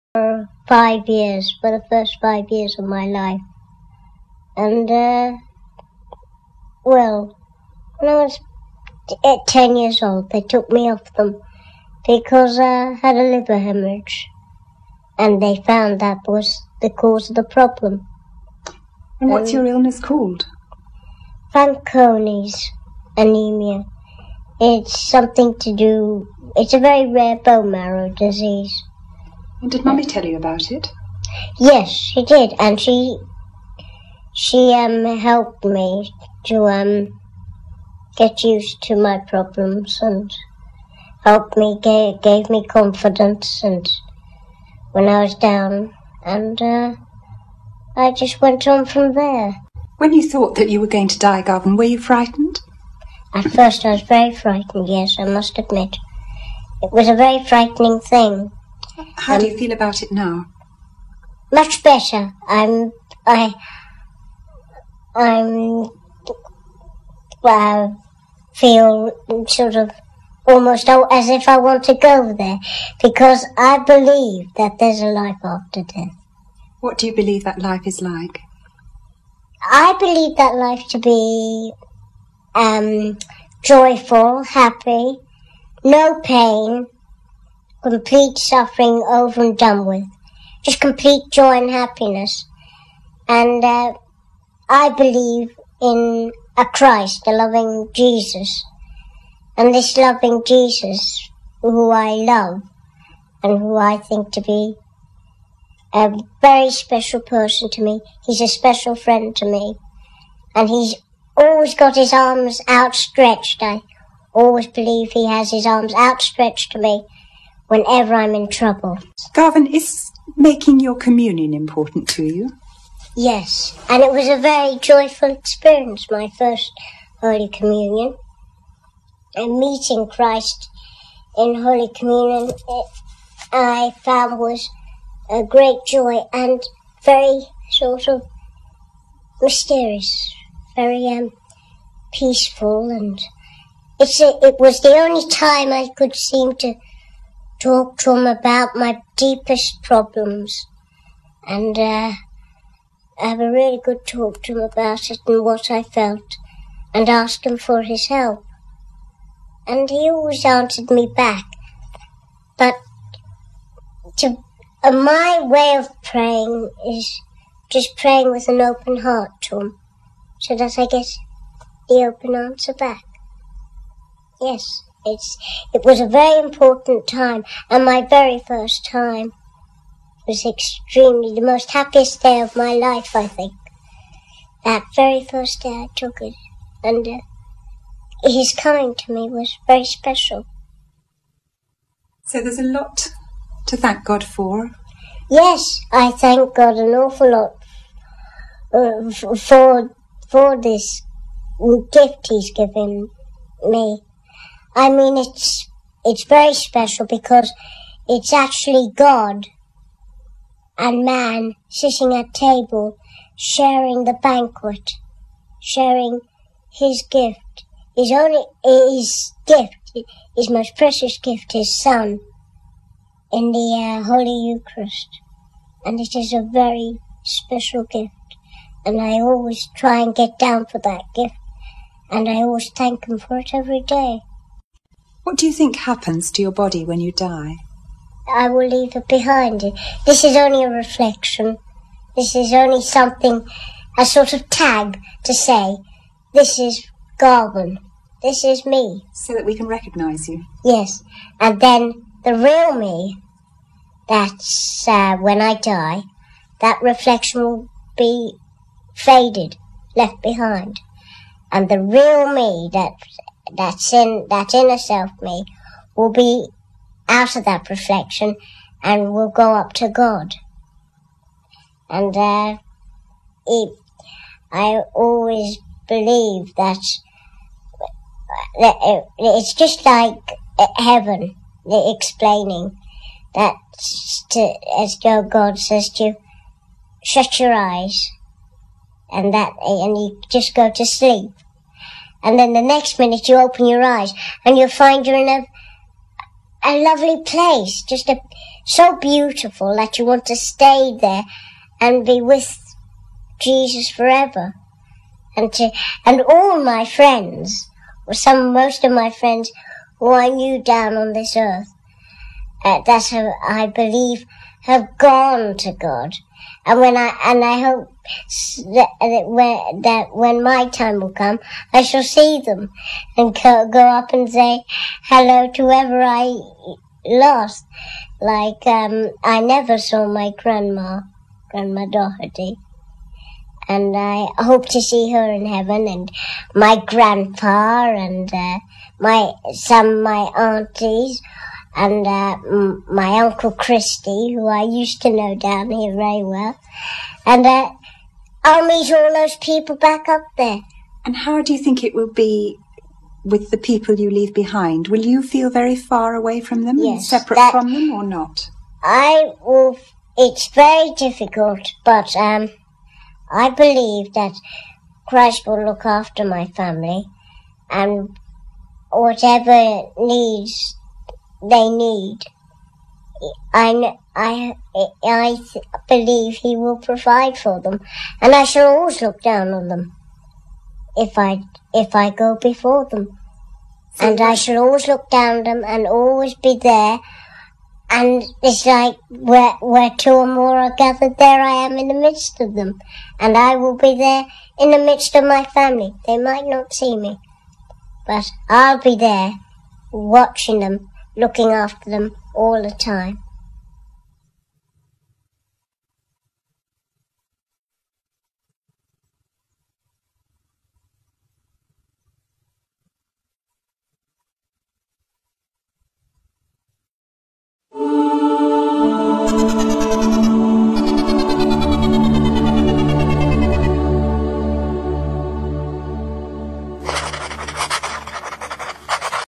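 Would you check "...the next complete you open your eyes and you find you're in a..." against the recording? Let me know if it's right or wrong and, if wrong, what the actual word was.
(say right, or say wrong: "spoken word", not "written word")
wrong: "minute", not "complete".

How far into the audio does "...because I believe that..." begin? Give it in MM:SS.
01:13.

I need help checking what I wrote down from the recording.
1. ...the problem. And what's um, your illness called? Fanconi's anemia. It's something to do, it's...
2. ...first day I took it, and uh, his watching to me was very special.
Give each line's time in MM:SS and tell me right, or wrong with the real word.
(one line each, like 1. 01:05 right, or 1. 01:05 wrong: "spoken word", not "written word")
1. 00:17 right
2. 03:05 wrong: "coming", not "watching".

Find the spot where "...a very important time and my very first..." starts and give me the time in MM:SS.
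02:55.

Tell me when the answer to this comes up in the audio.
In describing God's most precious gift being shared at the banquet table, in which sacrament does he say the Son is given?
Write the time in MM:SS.
03:44.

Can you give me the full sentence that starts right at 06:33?
And I will be there in the midst of my family.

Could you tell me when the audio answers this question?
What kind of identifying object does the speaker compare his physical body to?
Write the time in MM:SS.
04:04.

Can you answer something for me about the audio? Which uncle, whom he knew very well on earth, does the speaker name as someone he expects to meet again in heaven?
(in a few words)
Christy.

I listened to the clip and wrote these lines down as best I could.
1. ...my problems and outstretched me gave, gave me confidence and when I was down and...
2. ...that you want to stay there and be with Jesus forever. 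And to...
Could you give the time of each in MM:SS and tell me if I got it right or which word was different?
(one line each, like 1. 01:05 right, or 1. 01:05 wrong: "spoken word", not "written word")
1. 00:38 wrong: "helped", not "outstretched"
2. 04:59 right.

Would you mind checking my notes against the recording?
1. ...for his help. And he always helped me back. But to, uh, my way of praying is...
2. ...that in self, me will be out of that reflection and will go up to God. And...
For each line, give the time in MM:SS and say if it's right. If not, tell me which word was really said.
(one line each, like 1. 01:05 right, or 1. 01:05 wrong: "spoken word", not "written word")
1. 02:37 wrong: "answered", not "helped"
2. 04:24 right.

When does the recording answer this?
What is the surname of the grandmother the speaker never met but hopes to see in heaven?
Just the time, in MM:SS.
05:31.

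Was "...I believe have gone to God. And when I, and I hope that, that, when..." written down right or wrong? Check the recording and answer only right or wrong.
right.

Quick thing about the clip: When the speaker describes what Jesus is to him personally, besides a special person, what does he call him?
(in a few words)
special friend.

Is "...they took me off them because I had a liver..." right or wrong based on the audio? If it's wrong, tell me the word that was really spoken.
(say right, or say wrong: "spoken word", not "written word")
right.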